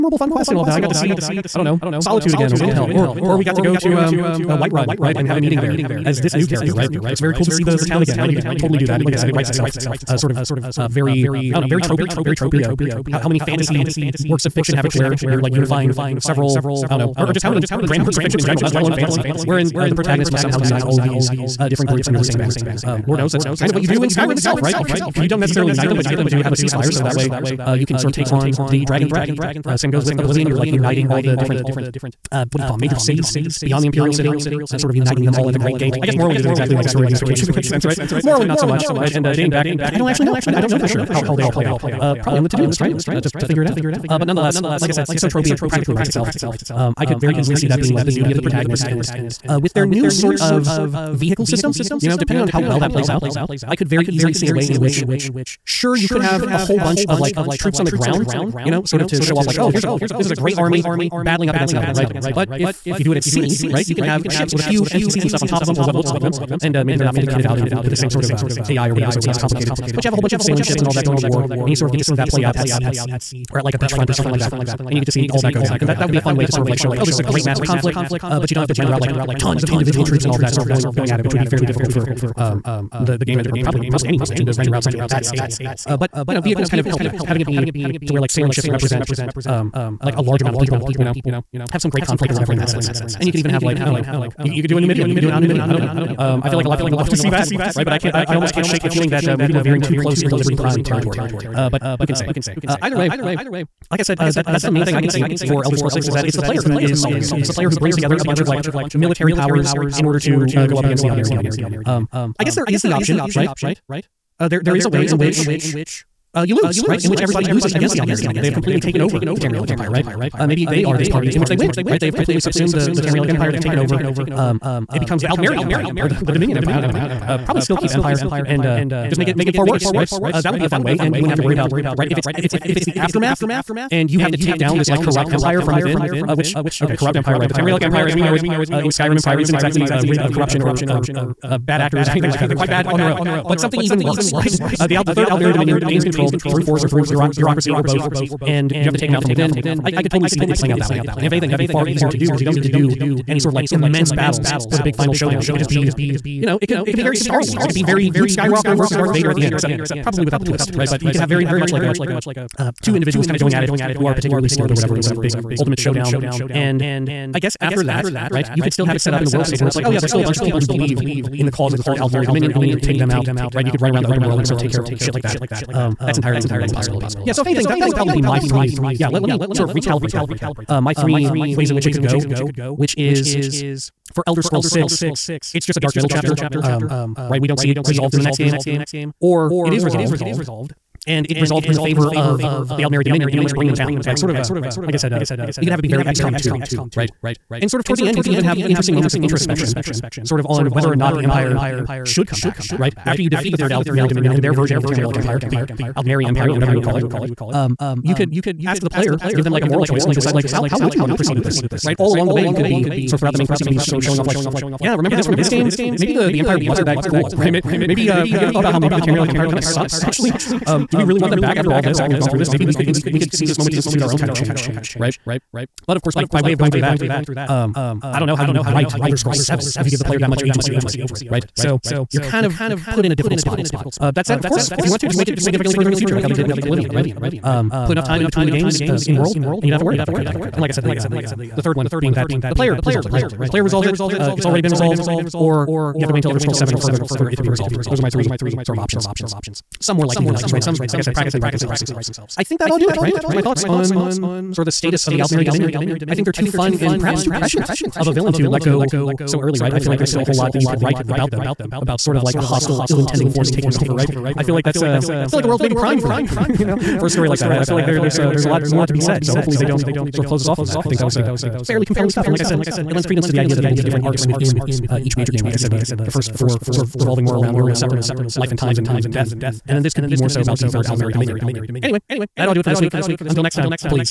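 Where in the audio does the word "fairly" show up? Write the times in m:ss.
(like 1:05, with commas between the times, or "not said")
1:21, 4:31.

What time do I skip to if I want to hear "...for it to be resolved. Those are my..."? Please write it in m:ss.
4:07.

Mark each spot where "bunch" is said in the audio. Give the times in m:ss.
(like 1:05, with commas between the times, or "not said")
0:56, 1:10, 1:48, 2:50.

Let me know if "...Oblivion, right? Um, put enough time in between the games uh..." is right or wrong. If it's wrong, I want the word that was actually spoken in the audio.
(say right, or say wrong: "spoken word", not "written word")
right.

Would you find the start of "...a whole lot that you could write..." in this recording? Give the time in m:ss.
4:20.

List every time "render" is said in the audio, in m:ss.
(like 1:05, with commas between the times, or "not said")
1:18, 1:24.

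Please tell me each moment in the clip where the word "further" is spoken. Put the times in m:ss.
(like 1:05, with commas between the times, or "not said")
3:55, 4:06.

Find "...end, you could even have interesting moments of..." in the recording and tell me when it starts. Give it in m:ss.
3:18.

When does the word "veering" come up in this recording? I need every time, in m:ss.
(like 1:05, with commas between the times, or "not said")
1:39.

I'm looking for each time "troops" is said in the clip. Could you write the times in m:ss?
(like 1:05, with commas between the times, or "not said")
0:57, 1:20.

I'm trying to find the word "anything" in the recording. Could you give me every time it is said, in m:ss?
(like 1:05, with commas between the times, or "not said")
2:22, 2:31, 2:57.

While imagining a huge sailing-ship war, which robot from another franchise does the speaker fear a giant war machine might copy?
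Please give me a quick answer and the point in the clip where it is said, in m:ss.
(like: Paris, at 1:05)
Liberty Prime, at 1:40.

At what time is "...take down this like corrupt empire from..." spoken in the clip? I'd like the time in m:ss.
2:14.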